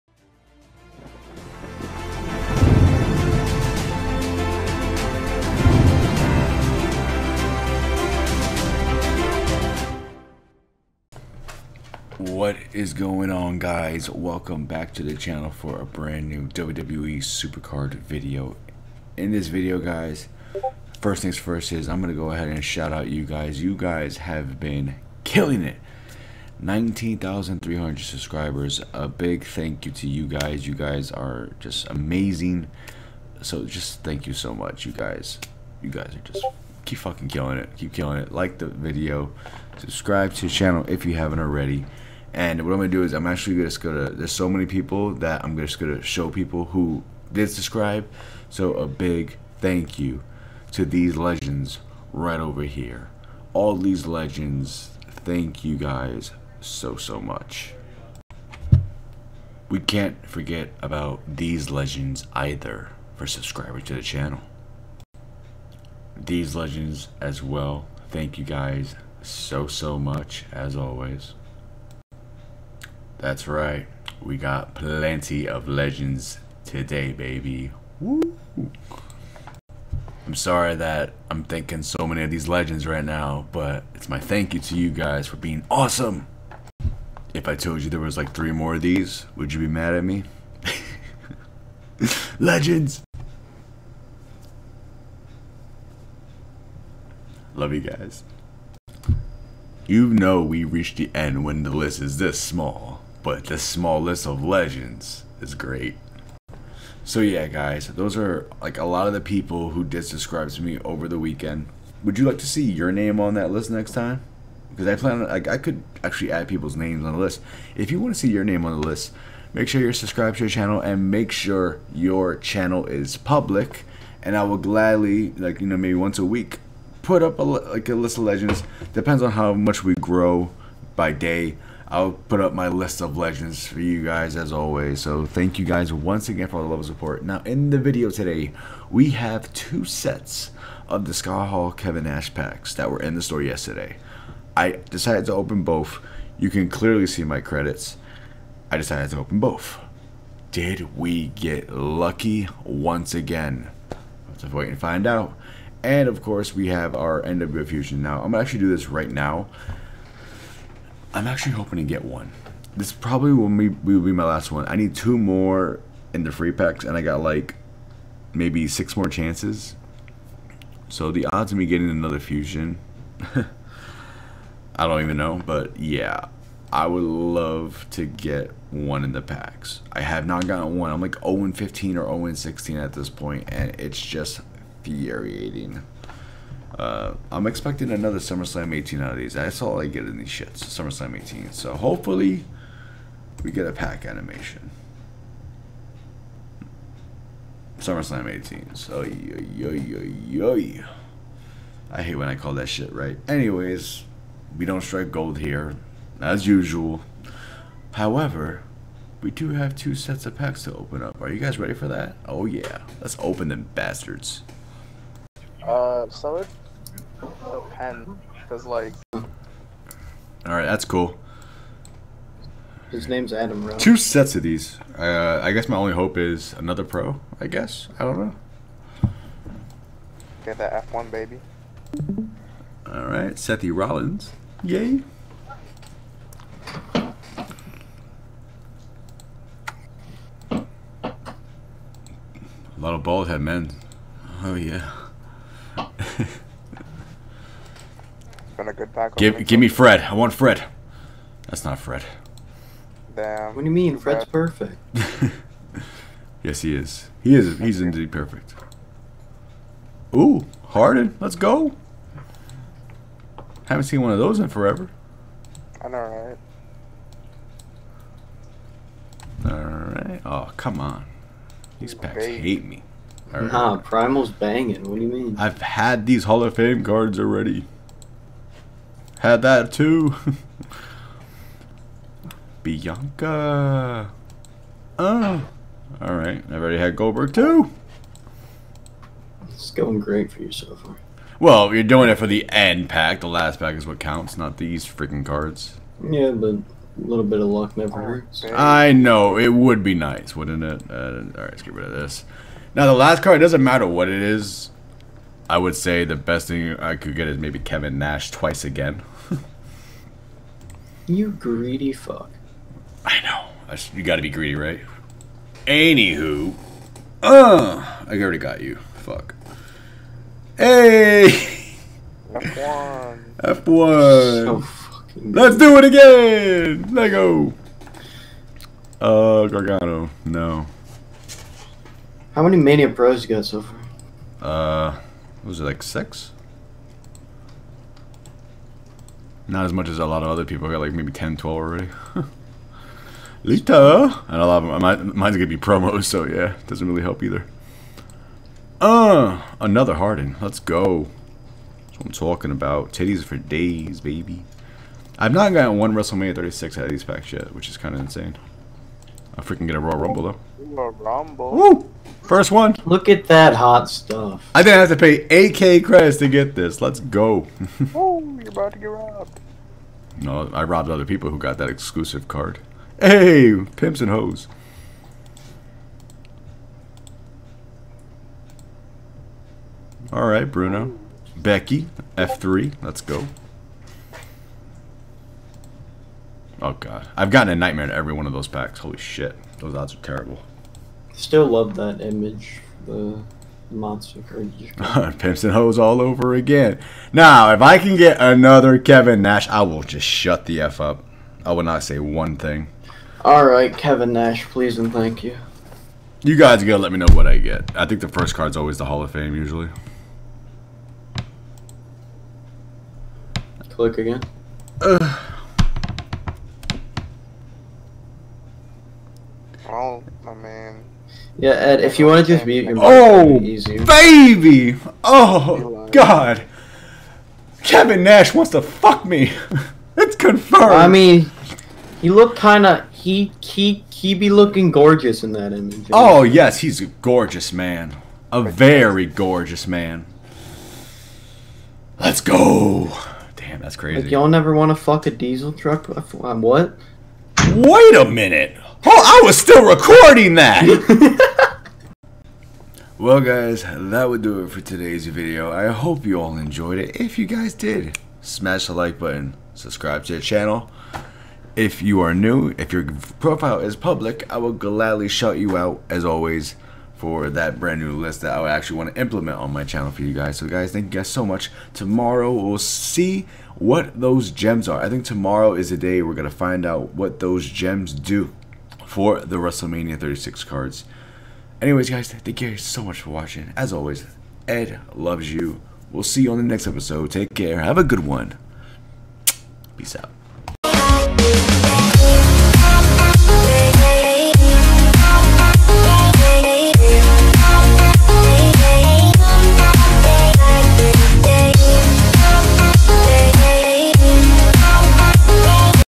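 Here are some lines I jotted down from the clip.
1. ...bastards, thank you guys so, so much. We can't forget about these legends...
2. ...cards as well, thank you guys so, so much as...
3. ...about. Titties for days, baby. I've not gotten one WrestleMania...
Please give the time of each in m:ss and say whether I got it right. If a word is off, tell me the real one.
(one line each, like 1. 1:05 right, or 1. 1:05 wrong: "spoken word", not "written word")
1. 0:54 wrong: "legends", not "bastards"
2. 1:06 wrong: "legends", not "cards"
3. 5:52 right.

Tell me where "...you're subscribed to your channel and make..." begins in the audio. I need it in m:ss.
1:59.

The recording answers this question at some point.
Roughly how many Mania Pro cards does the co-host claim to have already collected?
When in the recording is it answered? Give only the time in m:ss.
5:41.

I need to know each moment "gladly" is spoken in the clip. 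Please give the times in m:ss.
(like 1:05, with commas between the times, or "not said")
2:04, 7:44.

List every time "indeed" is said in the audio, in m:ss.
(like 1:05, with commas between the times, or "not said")
4:17.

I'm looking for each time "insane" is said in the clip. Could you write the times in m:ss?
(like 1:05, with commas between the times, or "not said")
5:57.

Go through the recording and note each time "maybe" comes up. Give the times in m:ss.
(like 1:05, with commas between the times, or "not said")
2:05, 2:48, 5:07, 5:40.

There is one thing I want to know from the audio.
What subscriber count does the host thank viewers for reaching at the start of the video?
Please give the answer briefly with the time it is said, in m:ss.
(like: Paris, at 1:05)
19,300, at 0:26.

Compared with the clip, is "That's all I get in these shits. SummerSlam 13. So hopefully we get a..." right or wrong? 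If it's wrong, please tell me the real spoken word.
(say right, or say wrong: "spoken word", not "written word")
wrong: "18", not "13".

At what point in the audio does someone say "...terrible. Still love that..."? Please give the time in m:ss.
6:29.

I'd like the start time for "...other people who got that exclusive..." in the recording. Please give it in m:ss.
6:10.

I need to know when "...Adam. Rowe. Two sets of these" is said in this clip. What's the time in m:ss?
3:43.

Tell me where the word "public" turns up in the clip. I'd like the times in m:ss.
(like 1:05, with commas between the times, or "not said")
2:03, 7:43.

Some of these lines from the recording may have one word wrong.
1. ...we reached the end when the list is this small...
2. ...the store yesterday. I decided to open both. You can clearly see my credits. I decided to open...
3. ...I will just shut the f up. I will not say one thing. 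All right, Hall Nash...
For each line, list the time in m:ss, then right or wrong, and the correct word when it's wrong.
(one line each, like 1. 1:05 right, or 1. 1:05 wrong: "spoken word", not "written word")
1. 1:40 right
2. 2:23 right
3. 6:39 wrong: "Kevin", not "Hall".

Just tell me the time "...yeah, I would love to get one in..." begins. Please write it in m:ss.
2:55.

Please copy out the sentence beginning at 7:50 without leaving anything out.
So guys, thank you guys so much.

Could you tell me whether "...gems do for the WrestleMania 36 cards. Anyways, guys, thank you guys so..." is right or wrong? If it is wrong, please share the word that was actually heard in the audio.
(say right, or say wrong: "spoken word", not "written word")
right.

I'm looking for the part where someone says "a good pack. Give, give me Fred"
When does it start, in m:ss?
4:08.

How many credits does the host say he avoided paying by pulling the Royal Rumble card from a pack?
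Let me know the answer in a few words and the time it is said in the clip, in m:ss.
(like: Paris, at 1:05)
8k, at 6:05.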